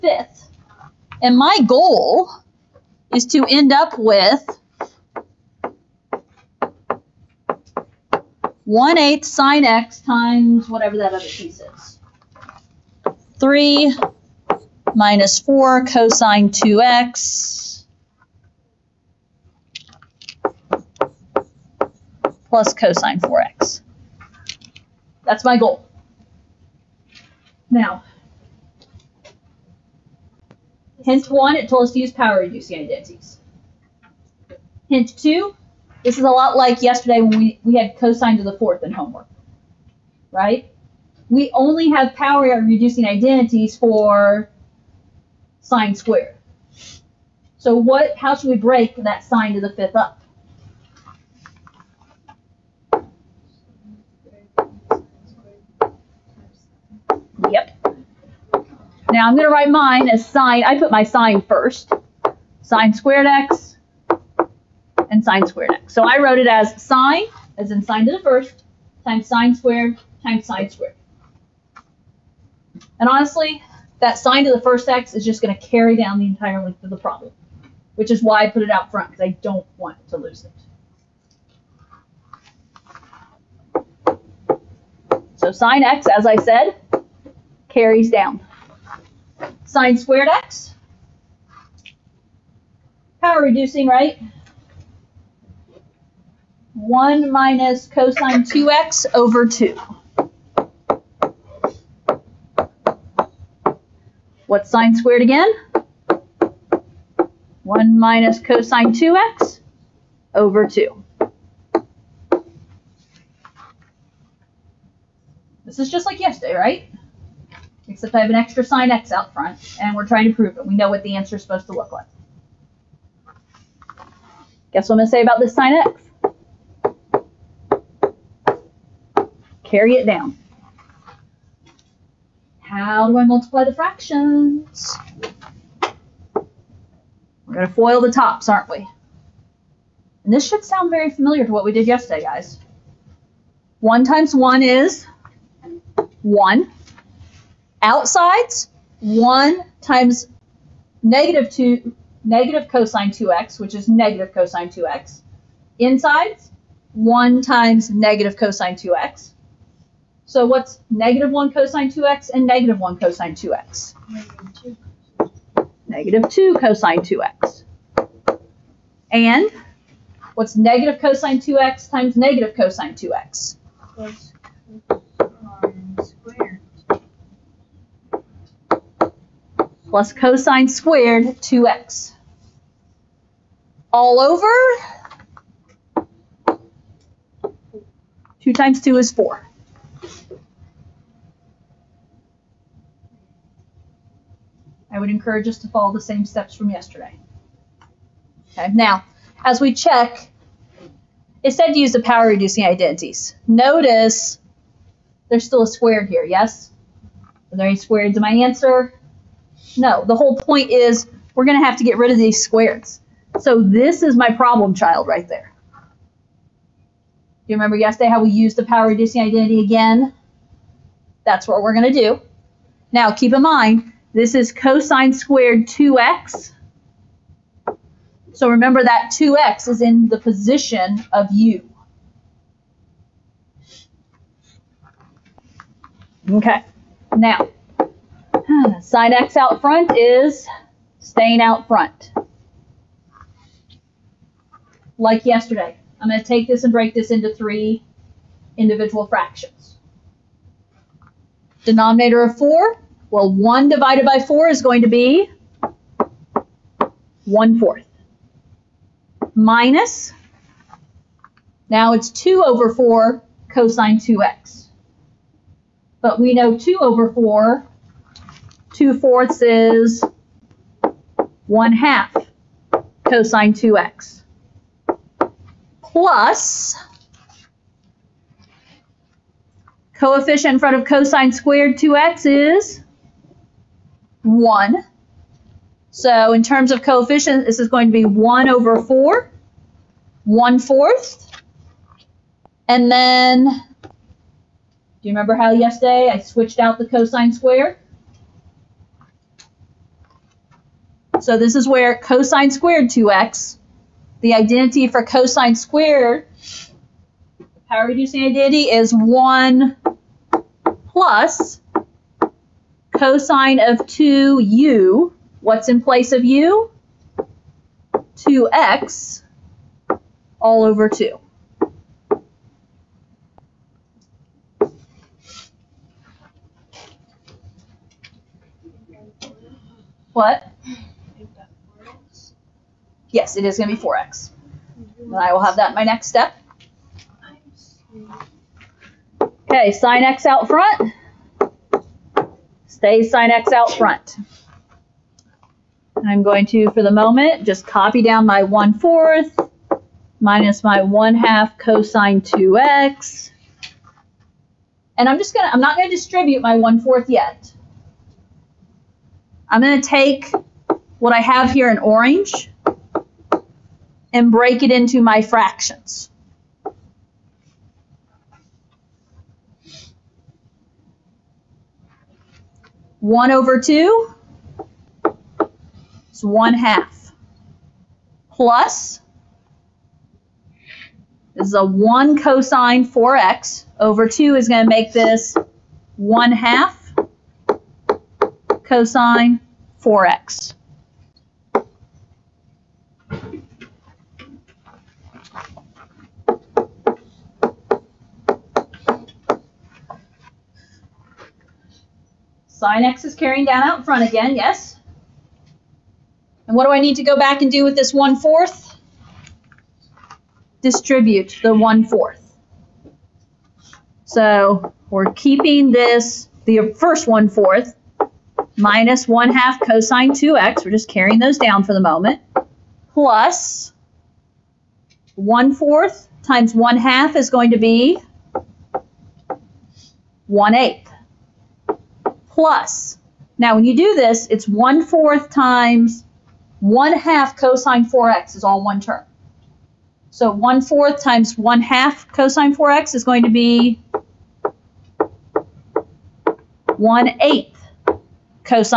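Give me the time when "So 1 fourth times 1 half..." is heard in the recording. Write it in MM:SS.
07:20.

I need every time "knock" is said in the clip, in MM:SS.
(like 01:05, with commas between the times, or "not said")
not said.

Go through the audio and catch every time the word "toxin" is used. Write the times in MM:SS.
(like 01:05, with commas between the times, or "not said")
not said.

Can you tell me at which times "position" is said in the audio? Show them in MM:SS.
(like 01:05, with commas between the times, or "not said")
03:50.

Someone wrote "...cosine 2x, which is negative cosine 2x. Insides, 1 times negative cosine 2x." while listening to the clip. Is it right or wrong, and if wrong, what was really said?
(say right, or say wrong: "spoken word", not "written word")
right.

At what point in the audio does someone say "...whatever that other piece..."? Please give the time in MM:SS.
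00:10.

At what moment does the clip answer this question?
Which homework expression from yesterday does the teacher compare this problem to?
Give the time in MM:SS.
00:37.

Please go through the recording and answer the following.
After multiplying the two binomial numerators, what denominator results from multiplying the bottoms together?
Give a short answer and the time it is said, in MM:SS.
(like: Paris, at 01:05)
4, at 03:08.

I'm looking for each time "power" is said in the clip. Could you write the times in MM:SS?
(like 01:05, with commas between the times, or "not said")
00:32, 00:42, 01:33, 03:22, 03:38, 05:07.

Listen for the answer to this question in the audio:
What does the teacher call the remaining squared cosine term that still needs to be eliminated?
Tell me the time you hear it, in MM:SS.
03:34.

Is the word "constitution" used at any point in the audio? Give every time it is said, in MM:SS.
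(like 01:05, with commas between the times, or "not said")
not said.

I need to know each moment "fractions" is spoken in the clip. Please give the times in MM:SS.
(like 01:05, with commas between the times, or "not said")
02:13, 04:09, 06:05.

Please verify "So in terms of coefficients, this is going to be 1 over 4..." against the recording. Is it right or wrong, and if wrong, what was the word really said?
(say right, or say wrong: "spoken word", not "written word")
right.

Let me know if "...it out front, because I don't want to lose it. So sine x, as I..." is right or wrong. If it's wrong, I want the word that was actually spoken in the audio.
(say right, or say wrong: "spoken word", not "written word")
right.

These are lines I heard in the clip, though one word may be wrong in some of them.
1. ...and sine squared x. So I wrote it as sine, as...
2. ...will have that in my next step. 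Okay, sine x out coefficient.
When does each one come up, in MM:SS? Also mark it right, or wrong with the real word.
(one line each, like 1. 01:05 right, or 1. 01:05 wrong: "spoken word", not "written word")
1. 01:05 right
2. 05:35 wrong: "front", not "coefficient".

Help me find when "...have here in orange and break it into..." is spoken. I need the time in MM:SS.
06:01.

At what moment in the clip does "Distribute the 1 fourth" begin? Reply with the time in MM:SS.
06:50.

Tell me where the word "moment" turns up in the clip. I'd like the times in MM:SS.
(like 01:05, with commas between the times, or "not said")
05:46, 07:01.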